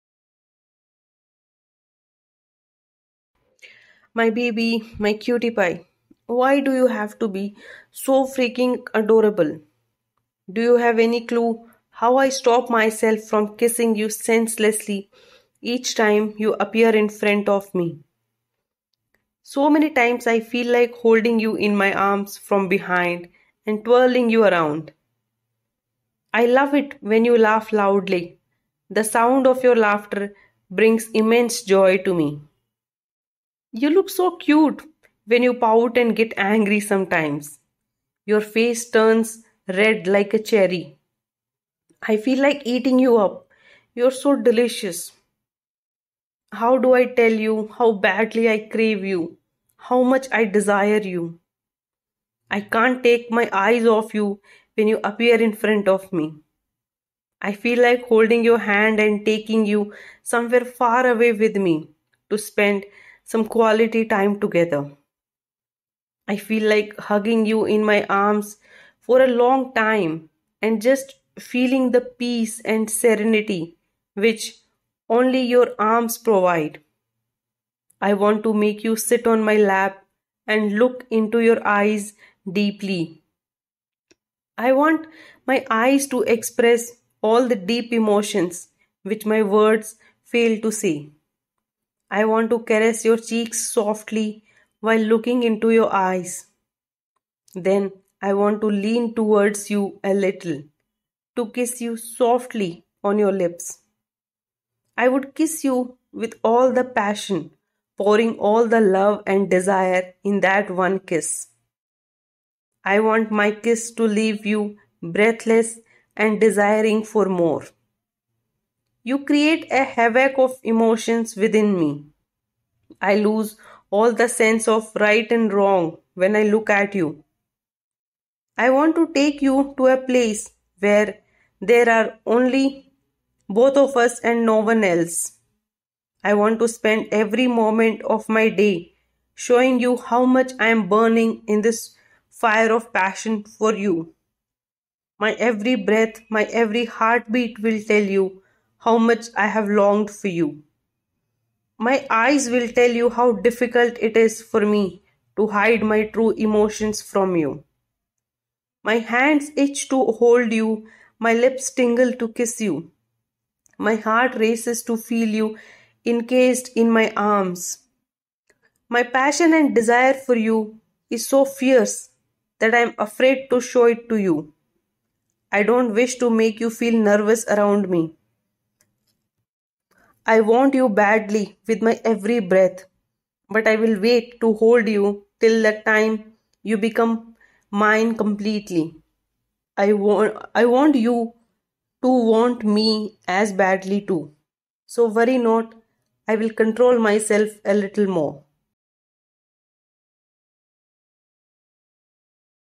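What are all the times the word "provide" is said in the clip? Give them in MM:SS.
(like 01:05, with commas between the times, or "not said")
01:16.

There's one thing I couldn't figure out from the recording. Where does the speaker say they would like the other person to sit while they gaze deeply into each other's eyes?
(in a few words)
lap.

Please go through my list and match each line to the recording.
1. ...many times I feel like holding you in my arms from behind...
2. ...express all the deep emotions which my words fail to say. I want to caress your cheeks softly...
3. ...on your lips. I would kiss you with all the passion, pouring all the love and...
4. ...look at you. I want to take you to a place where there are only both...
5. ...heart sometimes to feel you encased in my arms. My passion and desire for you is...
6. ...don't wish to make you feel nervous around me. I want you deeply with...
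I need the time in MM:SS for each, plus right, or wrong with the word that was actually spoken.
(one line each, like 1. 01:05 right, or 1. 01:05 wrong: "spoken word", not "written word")
1. 00:19 right
2. 01:26 right
3. 01:43 right
4. 02:06 right
5. 02:43 wrong: "races", not "sometimes"
6. 02:55 wrong: "badly", not "deeply".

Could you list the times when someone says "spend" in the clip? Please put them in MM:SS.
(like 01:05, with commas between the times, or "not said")
01:02, 02:16.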